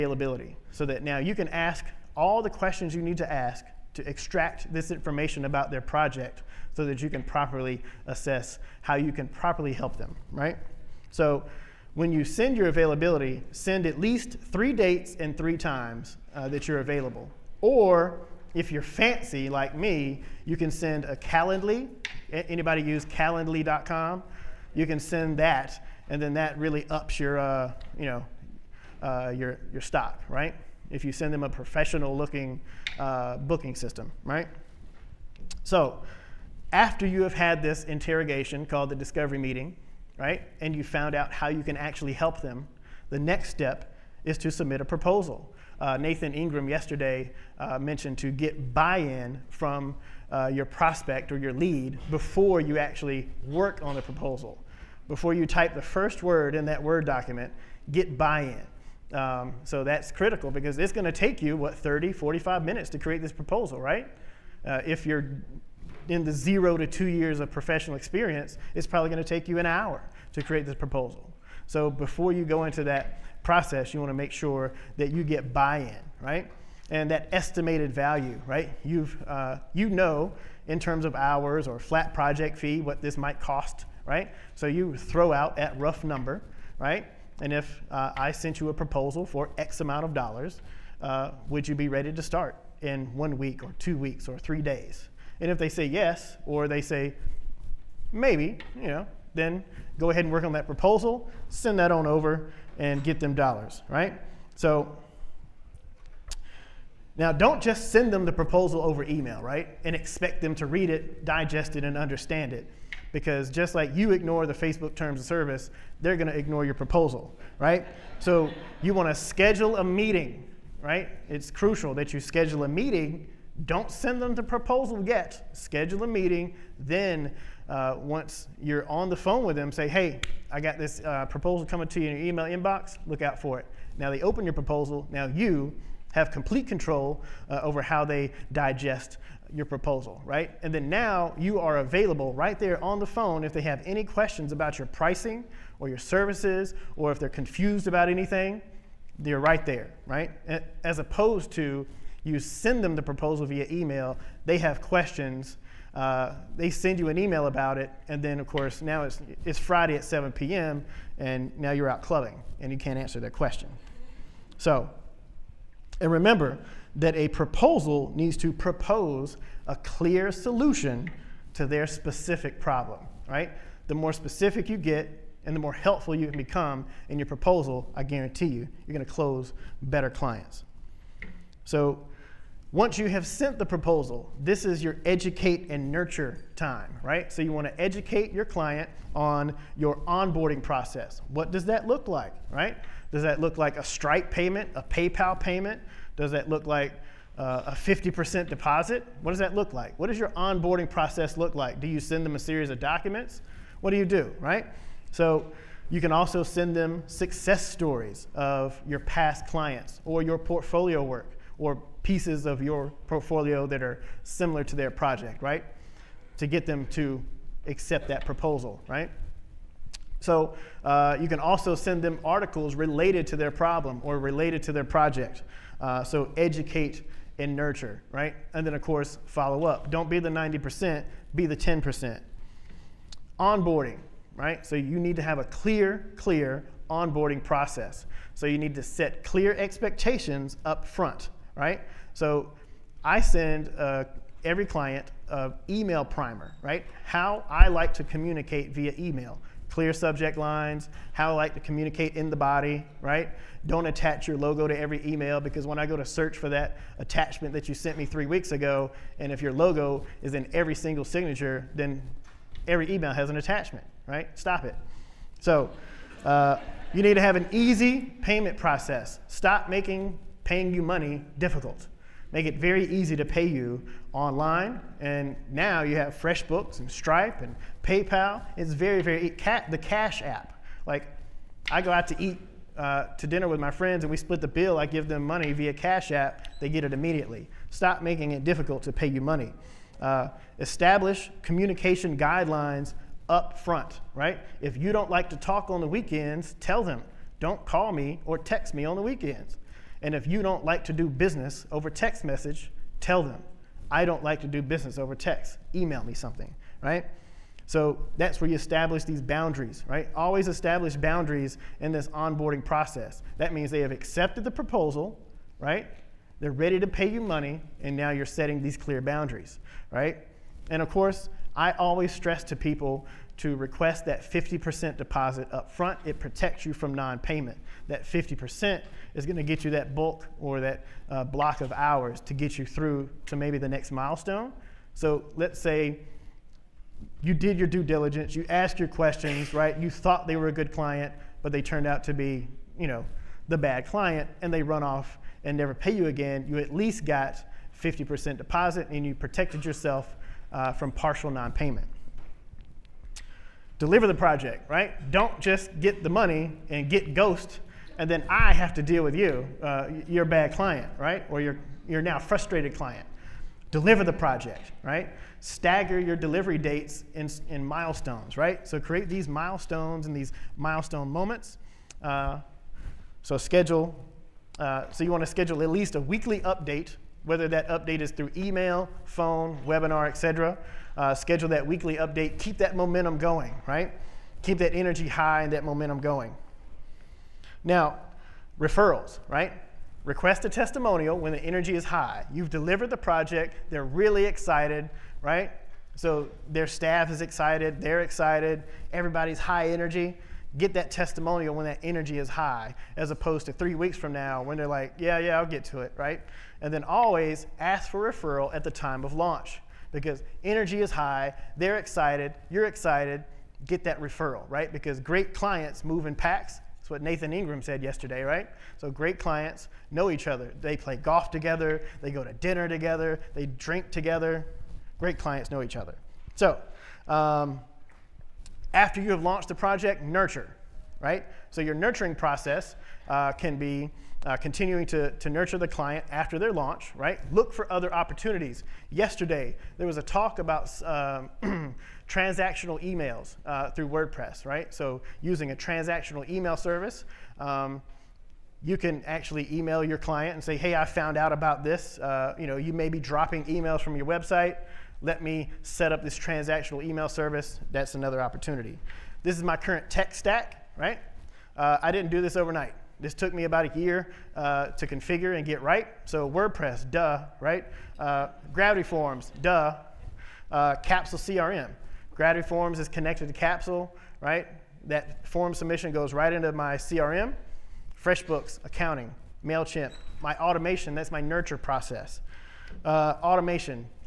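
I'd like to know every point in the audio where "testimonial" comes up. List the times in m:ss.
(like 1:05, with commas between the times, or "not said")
6:30, 6:40.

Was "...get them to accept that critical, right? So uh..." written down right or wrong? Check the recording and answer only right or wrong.
wrong.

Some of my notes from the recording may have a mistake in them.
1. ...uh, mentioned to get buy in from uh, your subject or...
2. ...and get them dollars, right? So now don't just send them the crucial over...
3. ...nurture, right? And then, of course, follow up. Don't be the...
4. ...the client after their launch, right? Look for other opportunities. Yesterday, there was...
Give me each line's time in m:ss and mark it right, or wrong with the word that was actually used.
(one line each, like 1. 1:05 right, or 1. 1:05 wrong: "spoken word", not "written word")
1. 0:47 wrong: "prospect", not "subject"
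2. 1:42 wrong: "proposal", not "crucial"
3. 3:47 right
4. 7:15 right.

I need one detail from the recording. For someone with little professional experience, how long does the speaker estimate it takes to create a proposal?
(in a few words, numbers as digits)
an hour.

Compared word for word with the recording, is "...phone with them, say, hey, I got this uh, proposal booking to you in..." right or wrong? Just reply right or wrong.
wrong.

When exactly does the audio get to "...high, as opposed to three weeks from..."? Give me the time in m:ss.
6:42.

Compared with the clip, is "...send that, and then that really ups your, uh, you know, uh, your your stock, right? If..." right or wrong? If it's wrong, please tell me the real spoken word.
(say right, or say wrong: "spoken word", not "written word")
right.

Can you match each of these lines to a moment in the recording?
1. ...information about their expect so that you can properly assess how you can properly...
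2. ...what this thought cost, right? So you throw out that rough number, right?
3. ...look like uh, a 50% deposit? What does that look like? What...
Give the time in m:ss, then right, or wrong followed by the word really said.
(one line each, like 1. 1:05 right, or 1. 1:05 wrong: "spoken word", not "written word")
1. 0:04 wrong: "project", not "expect"
2. 1:22 wrong: "might", not "thought"
3. 3:16 right.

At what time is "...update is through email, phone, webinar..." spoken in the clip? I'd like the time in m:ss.
6:17.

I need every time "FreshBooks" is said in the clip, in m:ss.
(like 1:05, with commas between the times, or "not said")
4:36, 7:58.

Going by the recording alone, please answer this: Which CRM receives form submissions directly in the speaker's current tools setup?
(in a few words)
Capsule CRM.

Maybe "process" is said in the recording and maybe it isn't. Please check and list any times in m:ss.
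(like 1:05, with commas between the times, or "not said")
1:13, 3:10, 3:20, 3:57, 4:28, 5:12, 7:12, 8:01.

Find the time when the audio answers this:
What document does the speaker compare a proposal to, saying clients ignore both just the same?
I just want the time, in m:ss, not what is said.
1:54.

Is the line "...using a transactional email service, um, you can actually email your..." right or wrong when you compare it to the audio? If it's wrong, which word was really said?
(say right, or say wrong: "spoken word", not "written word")
right.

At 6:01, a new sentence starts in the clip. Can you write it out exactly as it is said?
Or your, your now frustrated client.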